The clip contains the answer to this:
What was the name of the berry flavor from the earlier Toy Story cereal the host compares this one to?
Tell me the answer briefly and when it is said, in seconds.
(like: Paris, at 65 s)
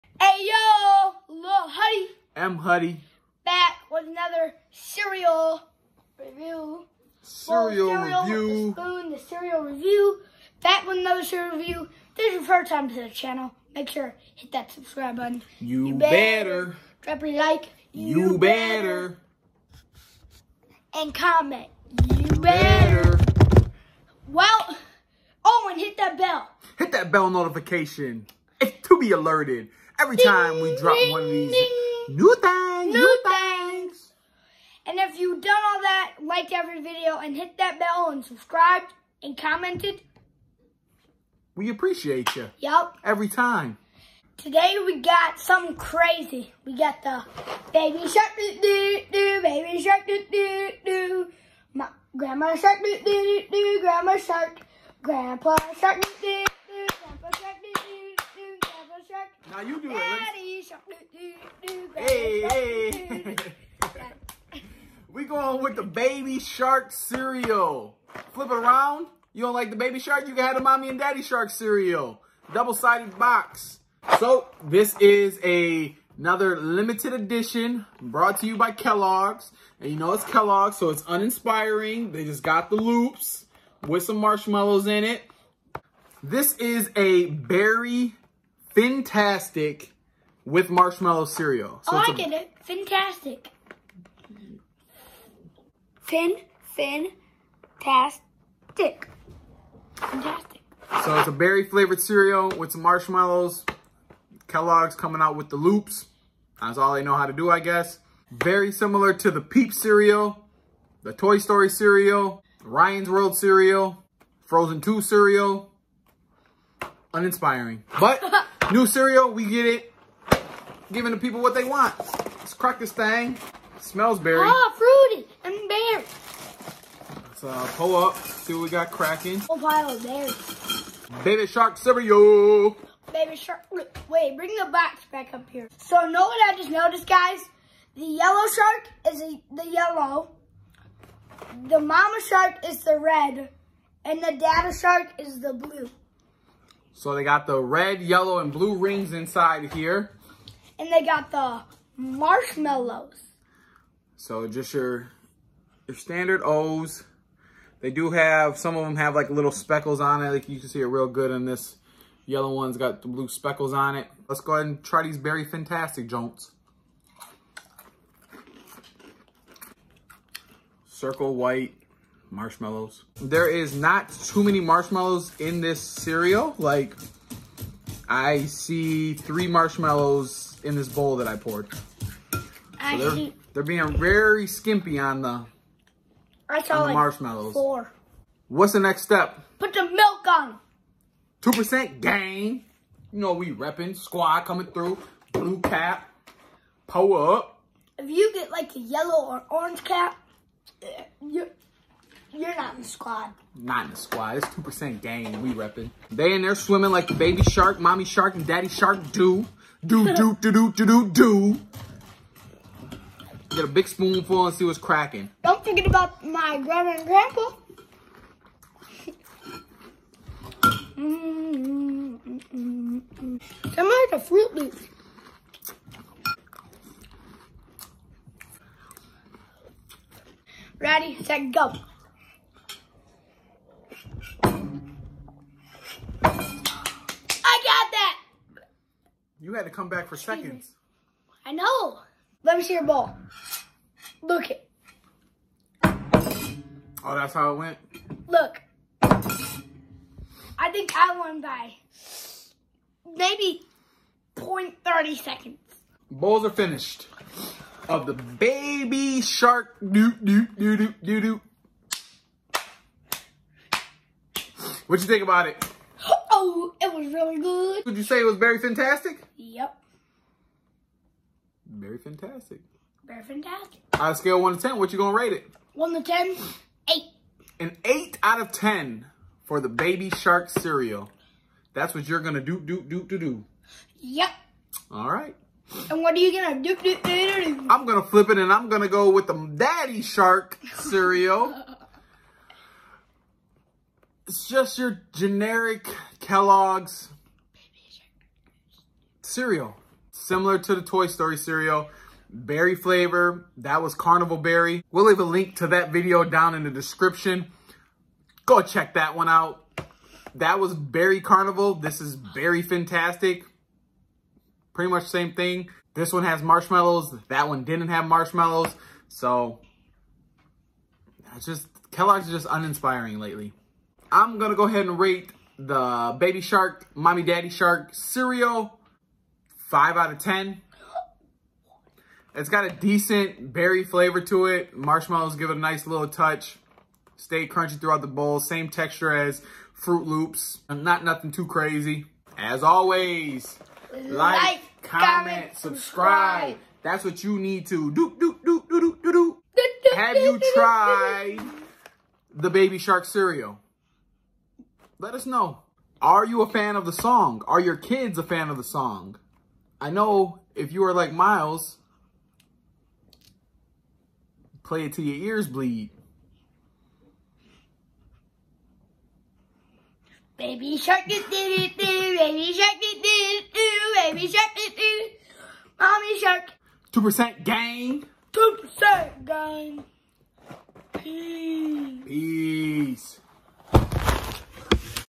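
Carnival Berry, at 303 s.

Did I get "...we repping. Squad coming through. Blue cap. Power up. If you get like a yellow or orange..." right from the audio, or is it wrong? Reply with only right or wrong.
right.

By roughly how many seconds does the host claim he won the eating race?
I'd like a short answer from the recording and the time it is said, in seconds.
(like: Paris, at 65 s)
0.30 seconds, at 254 s.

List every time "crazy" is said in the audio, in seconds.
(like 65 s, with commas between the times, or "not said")
45 s, 341 s.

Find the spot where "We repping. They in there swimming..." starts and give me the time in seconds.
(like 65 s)
205 s.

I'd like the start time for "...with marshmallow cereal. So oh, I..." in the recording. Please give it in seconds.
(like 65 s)
90 s.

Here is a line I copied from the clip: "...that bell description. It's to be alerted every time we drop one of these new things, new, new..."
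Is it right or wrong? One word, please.
wrong.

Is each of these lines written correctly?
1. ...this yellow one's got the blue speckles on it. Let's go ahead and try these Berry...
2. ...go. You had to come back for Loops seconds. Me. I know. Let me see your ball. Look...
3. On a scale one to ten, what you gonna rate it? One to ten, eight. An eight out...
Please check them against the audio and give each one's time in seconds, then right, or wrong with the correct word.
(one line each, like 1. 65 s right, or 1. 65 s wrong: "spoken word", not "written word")
1. 161 s right
2. 231 s wrong: "Excuse", not "Loops"
3. 273 s right.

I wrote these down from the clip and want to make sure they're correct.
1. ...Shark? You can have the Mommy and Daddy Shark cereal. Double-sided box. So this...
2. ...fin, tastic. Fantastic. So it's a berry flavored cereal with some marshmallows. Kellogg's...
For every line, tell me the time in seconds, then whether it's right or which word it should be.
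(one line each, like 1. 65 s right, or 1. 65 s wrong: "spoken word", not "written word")
1. 69 s right
2. 96 s right.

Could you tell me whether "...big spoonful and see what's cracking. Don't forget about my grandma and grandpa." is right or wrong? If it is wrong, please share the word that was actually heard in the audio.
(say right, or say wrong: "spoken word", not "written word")
right.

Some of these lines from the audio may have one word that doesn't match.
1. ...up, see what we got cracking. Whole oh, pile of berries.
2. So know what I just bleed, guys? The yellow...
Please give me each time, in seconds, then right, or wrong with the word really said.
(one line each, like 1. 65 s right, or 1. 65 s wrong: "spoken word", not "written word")
1. 127 s right
2. 135 s wrong: "noticed", not "bleed".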